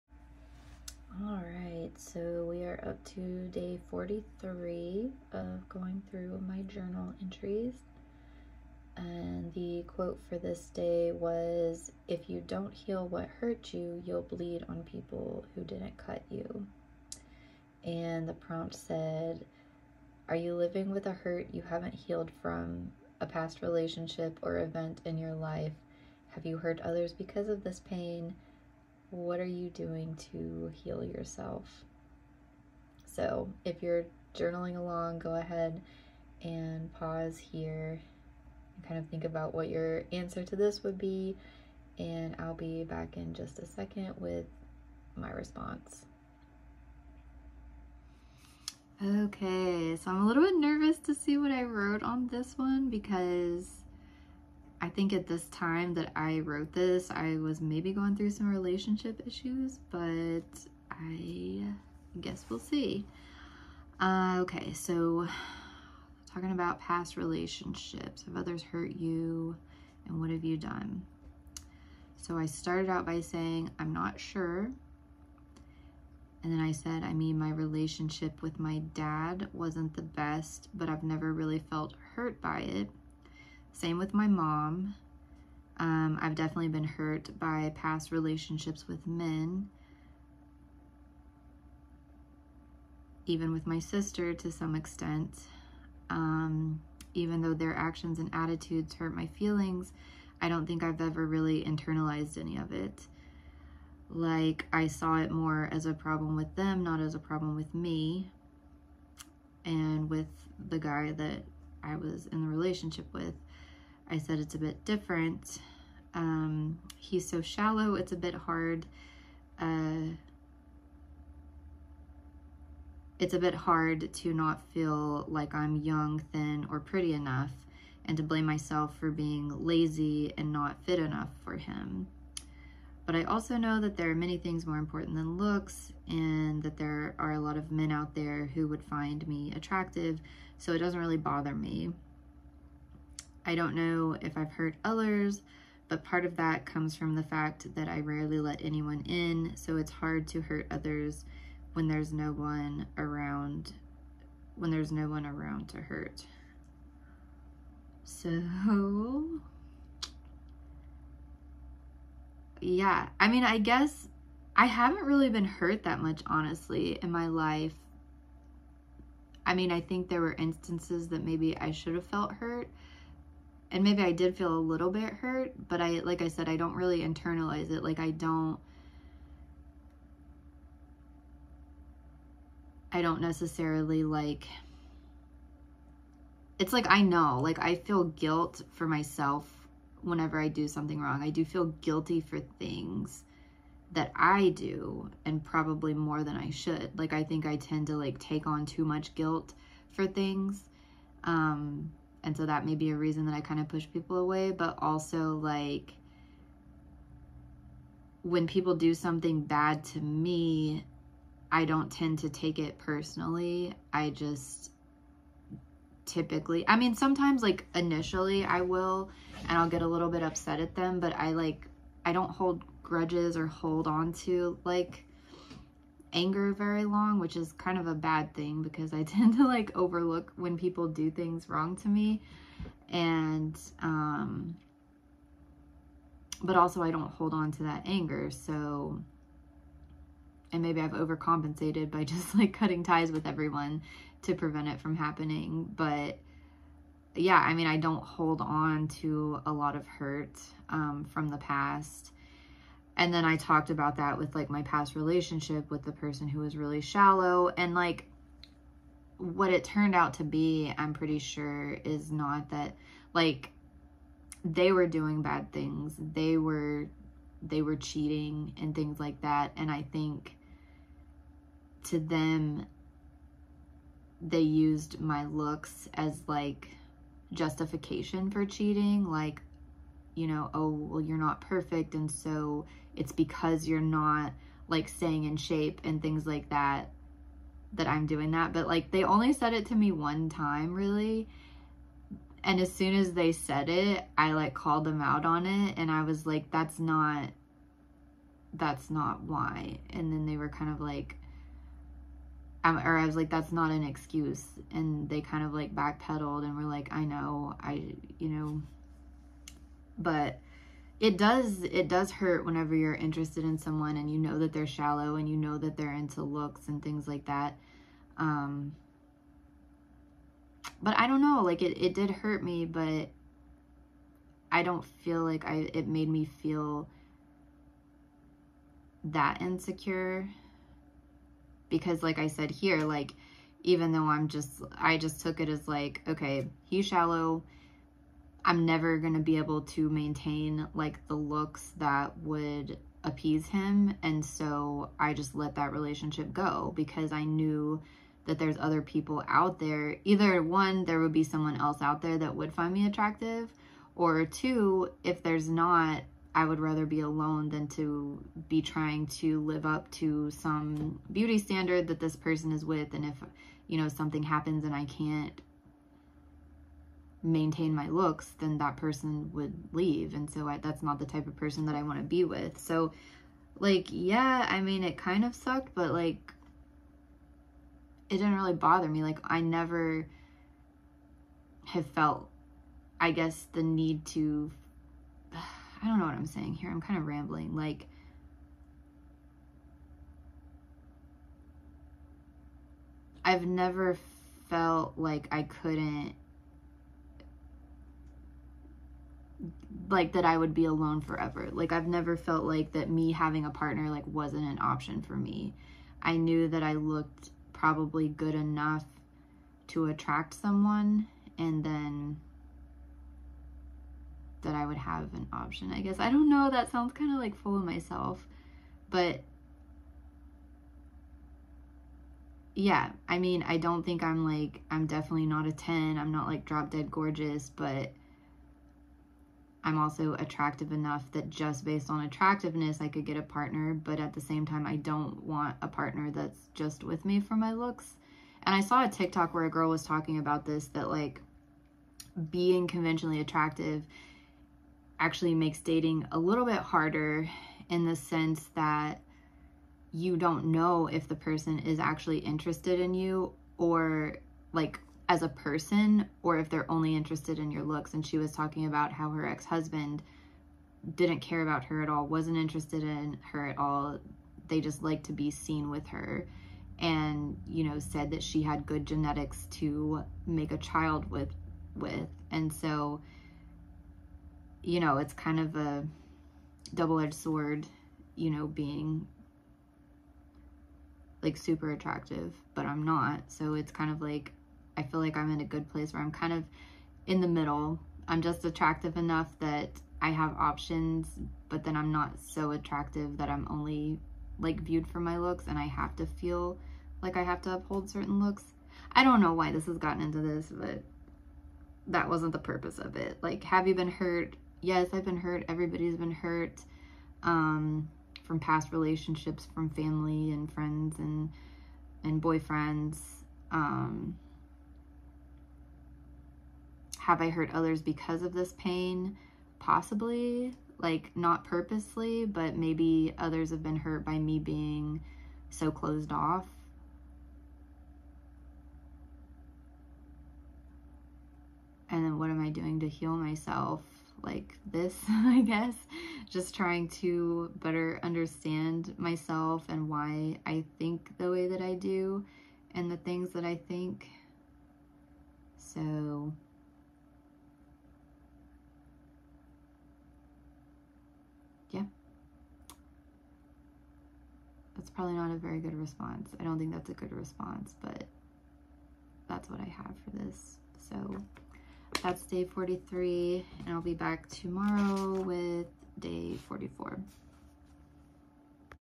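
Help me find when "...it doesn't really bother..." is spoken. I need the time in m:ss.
2:20.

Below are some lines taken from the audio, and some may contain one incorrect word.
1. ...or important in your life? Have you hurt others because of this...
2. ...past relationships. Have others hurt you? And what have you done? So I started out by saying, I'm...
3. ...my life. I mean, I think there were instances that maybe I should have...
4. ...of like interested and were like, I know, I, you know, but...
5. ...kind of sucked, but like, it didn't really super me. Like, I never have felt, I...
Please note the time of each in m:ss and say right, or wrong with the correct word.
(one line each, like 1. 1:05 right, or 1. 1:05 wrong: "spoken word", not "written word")
1. 0:24 wrong: "event", not "important"
2. 1:06 right
3. 2:47 right
4. 5:05 wrong: "backpedaled", not "interested"
5. 6:14 wrong: "bother", not "super".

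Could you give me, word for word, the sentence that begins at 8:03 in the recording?
So it's kind of like, I feel like I'm in a good place where I'm kind of in the middle.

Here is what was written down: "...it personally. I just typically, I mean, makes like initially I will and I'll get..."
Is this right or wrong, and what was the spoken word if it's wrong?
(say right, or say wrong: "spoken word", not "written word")
wrong: "sometimes", not "makes".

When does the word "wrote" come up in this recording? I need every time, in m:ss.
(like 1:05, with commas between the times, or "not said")
0:51, 0:56.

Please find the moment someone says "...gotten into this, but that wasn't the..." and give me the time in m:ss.
8:19.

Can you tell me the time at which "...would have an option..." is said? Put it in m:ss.
6:54.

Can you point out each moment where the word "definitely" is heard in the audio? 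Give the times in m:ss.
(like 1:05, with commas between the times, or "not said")
1:26, 7:04.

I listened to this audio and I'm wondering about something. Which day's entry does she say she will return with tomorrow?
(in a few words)
Day 44.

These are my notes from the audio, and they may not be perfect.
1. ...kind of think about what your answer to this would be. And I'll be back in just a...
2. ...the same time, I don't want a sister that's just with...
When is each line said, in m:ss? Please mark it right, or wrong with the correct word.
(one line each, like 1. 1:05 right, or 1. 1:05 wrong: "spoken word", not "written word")
1. 0:38 right
2. 7:14 wrong: "partner", not "sister".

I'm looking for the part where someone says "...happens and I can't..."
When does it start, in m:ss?
6:04.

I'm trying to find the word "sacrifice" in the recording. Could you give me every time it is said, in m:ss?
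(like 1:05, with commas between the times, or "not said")
not said.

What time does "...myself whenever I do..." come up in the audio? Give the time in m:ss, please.
3:08.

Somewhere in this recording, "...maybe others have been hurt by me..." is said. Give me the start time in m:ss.
8:42.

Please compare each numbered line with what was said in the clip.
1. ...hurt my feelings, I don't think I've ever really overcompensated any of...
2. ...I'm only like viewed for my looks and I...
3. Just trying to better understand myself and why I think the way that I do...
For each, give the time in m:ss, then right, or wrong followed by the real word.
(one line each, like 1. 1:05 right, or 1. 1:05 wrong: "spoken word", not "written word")
1. 1:38 wrong: "internalized", not "overcompensated"
2. 8:13 right
3. 8:56 right.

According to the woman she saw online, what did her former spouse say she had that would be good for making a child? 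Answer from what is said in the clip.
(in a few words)
Good genetics.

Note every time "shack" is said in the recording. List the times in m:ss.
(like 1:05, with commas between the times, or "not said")
not said.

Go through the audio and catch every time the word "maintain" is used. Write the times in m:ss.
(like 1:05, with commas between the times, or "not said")
5:39, 6:07.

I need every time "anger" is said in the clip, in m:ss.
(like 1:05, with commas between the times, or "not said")
3:46, 3:57.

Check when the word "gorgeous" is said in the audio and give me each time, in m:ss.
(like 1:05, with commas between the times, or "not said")
7:06.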